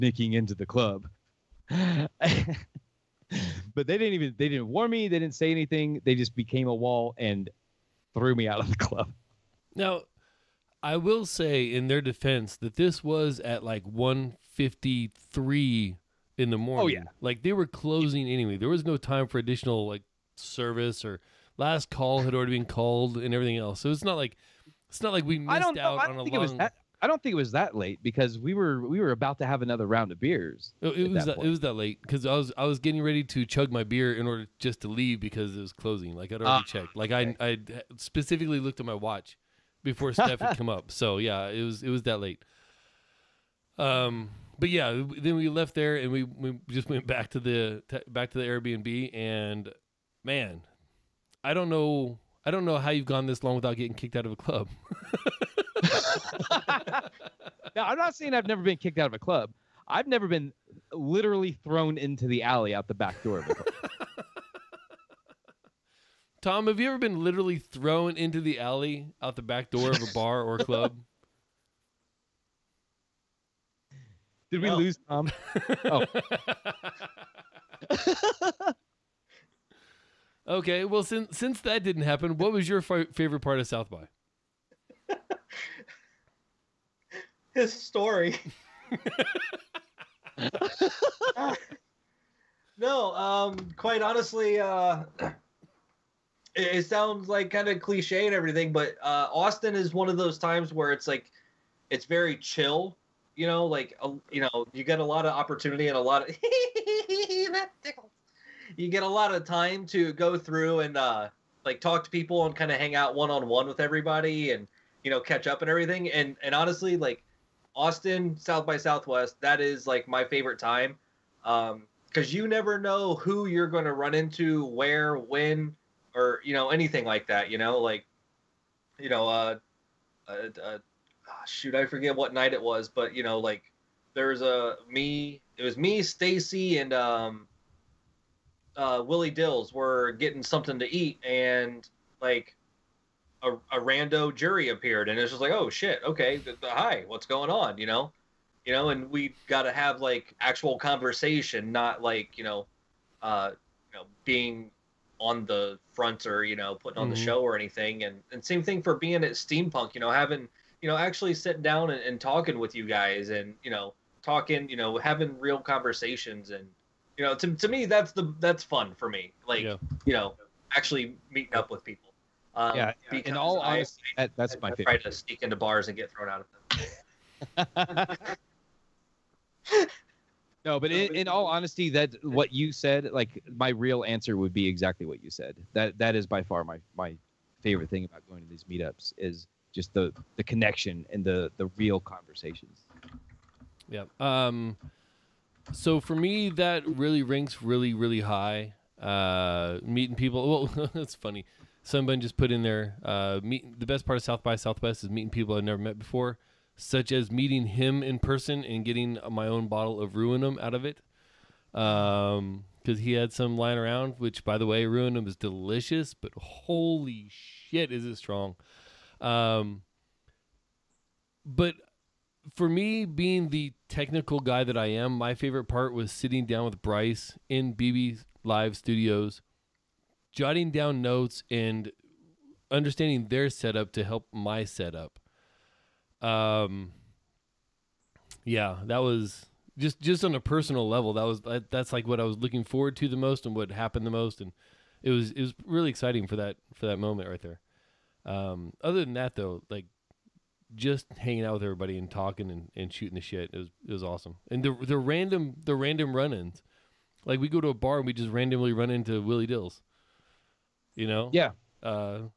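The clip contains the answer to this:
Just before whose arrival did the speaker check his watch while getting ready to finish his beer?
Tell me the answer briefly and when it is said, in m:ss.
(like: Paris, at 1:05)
Steph, at 0:40.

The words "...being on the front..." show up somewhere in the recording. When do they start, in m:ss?
2:34.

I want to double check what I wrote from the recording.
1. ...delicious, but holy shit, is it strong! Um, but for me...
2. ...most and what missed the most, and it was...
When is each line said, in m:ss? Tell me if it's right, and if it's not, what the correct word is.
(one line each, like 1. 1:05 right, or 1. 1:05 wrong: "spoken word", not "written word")
1. 3:35 right
2. 4:03 wrong: "happened", not "missed".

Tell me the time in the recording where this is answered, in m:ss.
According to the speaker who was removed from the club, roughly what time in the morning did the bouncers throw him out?
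0:13.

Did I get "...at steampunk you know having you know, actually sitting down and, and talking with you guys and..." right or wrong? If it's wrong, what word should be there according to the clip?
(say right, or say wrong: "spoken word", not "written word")
right.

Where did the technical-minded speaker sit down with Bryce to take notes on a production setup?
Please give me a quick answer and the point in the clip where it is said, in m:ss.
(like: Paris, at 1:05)
BB Live Studios, at 3:47.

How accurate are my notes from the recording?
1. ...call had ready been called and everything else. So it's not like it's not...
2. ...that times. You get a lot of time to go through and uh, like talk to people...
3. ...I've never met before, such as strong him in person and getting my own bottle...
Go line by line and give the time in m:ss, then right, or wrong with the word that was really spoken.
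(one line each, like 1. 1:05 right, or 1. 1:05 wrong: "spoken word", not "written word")
1. 0:21 wrong: "already", not "ready"
2. 1:46 wrong: "tickles", not "times"
3. 3:25 wrong: "meeting", not "strong".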